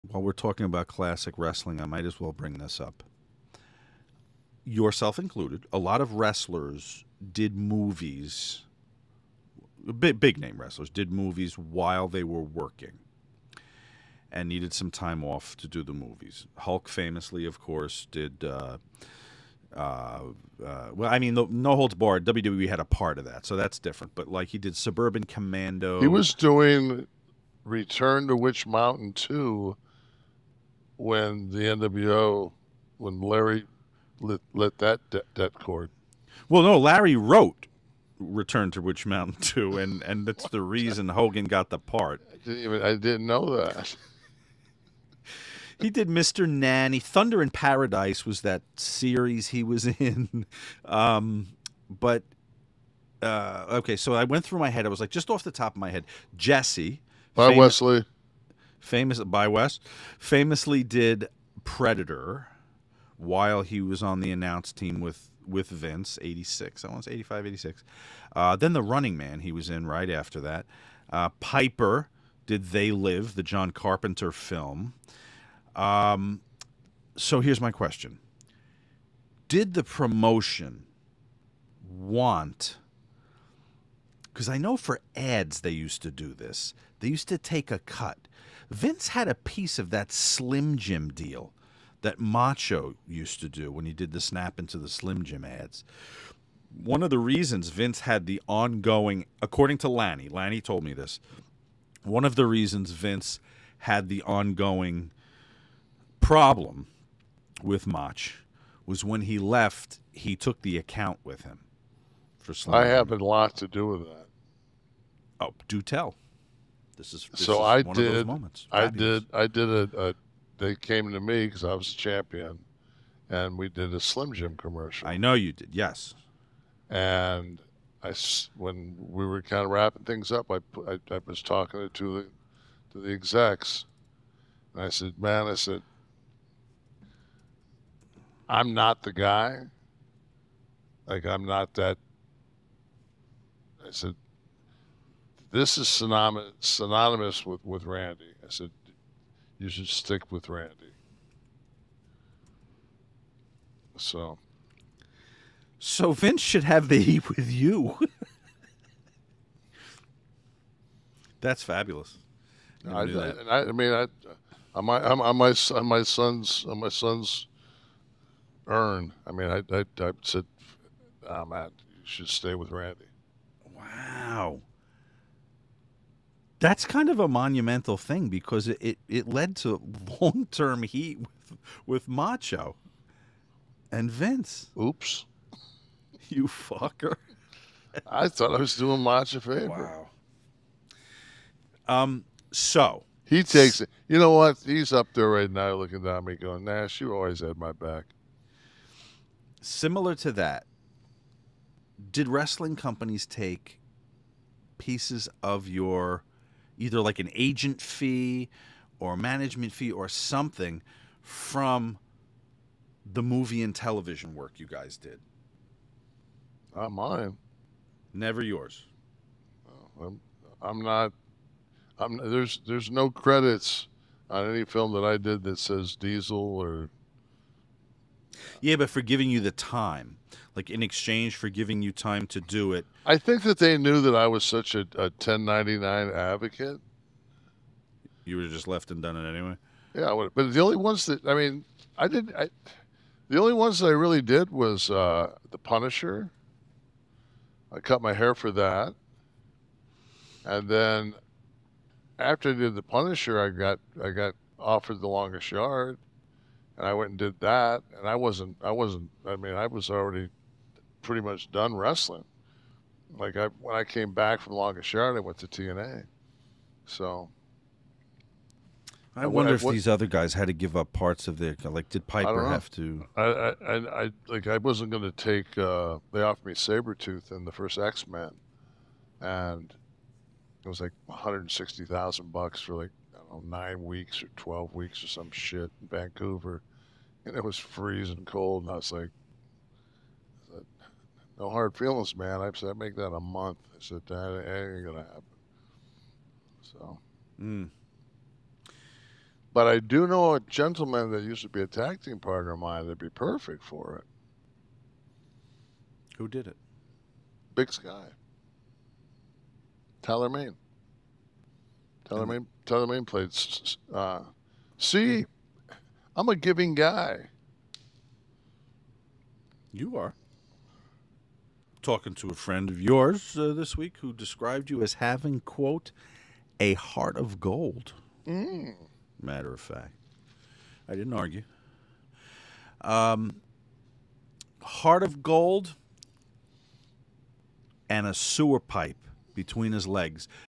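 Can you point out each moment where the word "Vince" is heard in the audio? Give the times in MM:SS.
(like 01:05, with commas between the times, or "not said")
01:05, 01:28, 01:37, 01:42, 02:36, 03:04.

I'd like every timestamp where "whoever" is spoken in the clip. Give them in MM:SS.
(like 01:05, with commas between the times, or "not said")
not said.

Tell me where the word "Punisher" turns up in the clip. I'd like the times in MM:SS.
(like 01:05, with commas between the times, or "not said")
04:05, 04:12.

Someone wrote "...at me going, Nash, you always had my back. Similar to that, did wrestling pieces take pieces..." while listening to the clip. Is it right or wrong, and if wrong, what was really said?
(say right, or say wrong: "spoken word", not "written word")
wrong: "companies", not "pieces".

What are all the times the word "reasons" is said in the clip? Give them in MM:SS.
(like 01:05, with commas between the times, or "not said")
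00:40, 01:37, 01:42.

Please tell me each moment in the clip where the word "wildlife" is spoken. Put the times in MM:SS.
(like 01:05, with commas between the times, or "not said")
not said.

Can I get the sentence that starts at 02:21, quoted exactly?
Like I'm not that I said, this is synonymous, synonymous with, with Randy.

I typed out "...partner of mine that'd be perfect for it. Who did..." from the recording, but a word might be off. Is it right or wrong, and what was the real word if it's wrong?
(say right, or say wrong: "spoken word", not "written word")
right.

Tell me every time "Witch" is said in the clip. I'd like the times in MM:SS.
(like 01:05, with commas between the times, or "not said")
00:28, 00:38.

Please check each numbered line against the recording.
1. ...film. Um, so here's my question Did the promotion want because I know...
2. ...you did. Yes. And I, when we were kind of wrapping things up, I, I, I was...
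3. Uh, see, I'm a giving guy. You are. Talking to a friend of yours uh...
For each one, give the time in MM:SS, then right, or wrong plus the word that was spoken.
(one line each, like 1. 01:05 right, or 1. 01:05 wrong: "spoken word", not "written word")
1. 01:14 right
2. 02:05 right
3. 05:13 right.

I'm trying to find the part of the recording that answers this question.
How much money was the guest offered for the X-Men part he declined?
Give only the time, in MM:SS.
04:41.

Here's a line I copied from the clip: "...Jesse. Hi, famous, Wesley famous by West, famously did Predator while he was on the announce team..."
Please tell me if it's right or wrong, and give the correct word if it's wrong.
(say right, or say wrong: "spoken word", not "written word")
right.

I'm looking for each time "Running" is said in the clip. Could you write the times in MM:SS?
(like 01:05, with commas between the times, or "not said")
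01:08.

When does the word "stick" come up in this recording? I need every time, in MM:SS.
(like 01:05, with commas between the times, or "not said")
02:29.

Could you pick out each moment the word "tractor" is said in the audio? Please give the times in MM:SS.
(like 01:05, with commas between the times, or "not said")
not said.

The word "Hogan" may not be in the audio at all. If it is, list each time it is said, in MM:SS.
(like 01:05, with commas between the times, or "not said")
00:41.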